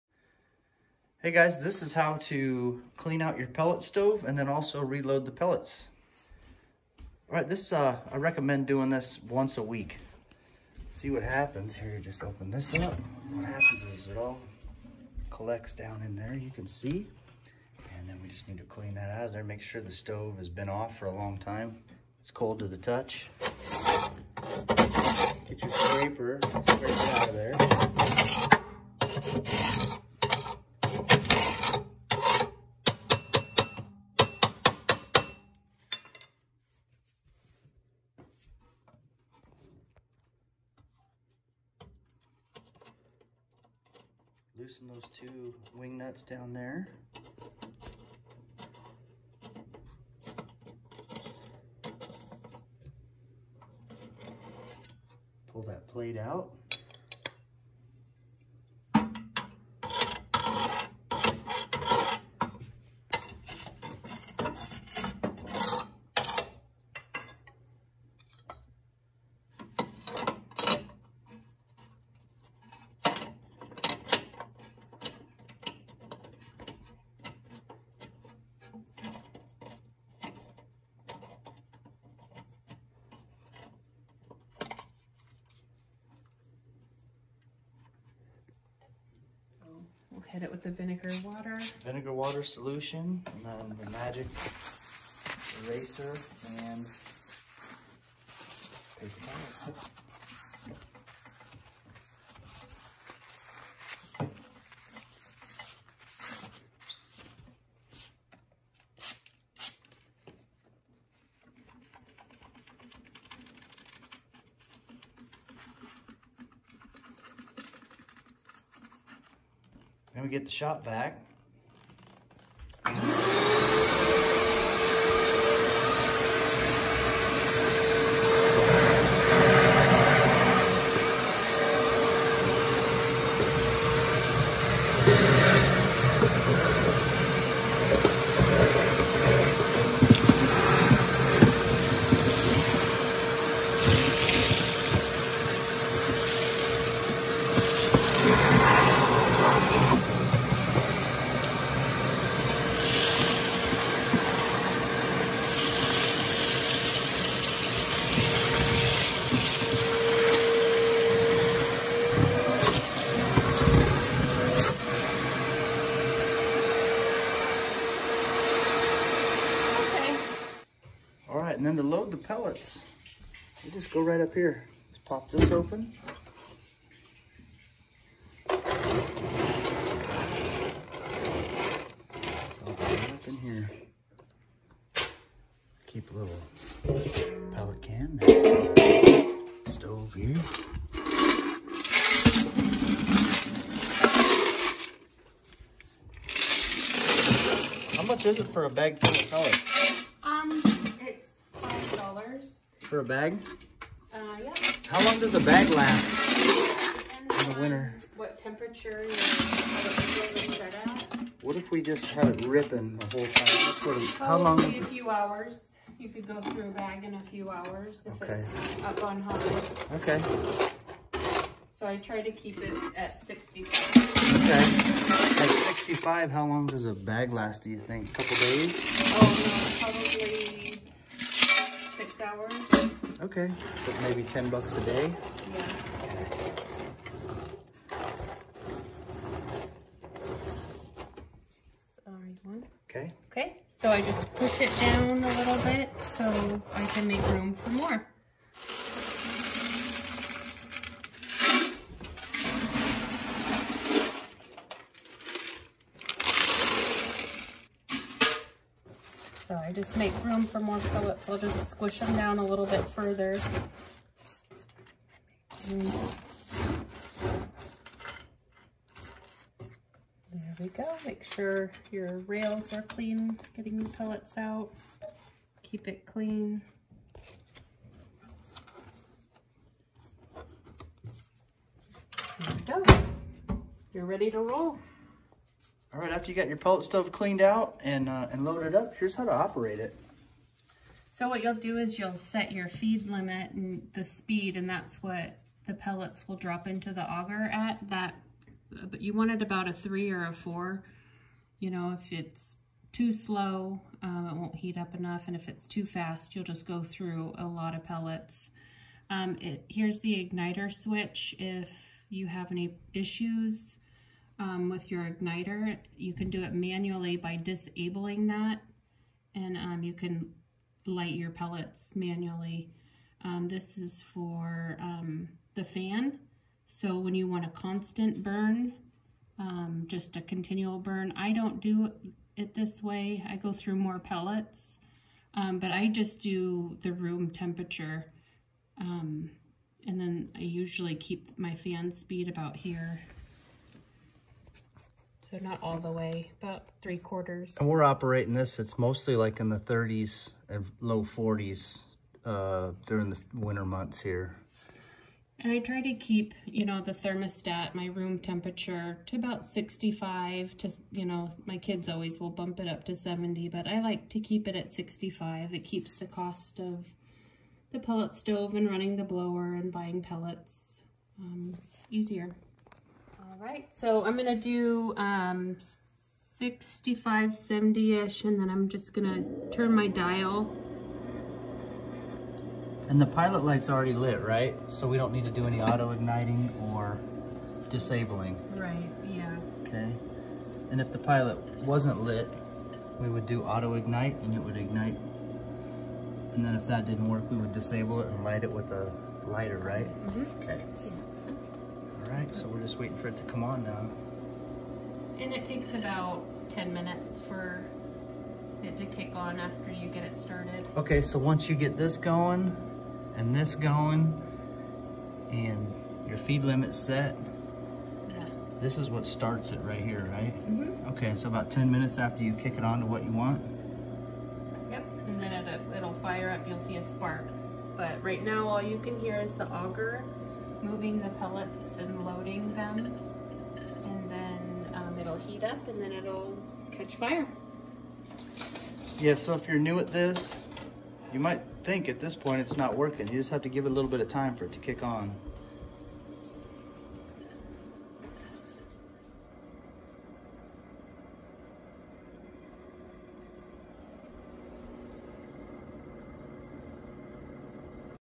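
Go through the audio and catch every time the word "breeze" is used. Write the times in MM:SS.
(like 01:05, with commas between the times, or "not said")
not said.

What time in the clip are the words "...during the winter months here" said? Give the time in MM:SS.
05:52.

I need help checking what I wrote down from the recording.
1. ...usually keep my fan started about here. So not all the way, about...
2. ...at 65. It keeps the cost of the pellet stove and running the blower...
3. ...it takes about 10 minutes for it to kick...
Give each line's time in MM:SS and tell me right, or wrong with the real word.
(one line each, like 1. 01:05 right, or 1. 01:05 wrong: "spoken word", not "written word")
1. 05:40 wrong: "speed", not "started"
2. 06:04 right
3. 06:45 right.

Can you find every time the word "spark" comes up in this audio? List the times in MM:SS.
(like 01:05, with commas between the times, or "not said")
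07:06.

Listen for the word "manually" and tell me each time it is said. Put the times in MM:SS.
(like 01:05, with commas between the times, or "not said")
05:16, 05:21.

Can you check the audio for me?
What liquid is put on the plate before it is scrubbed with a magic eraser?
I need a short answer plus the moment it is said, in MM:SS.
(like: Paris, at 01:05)
Vinegar water, at 01:31.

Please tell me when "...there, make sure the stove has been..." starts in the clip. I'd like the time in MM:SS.
00:19.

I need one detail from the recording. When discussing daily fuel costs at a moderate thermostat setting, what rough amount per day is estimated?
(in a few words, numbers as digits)
$10.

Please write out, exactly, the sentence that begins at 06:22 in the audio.
And the pilot light's already lit, right?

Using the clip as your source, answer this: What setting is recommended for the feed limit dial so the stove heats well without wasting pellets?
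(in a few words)
3 or 4.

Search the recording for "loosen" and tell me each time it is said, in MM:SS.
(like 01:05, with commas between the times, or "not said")
00:44.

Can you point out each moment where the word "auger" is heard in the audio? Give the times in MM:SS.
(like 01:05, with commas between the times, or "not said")
04:57, 07:09.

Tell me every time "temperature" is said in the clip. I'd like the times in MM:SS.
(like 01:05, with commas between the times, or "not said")
03:28, 05:37, 05:58.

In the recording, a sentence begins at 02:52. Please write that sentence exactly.
load the pellets, they just go right up here.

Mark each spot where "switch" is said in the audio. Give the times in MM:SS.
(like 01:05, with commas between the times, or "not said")
05:10.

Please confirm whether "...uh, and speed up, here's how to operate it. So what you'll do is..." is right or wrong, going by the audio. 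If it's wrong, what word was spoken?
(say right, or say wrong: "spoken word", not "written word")
wrong: "loaded", not "speed".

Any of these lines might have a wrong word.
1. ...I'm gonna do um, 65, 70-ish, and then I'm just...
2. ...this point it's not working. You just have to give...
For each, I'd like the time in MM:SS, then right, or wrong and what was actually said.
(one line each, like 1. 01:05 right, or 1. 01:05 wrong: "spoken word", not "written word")
1. 06:14 right
2. 07:21 right.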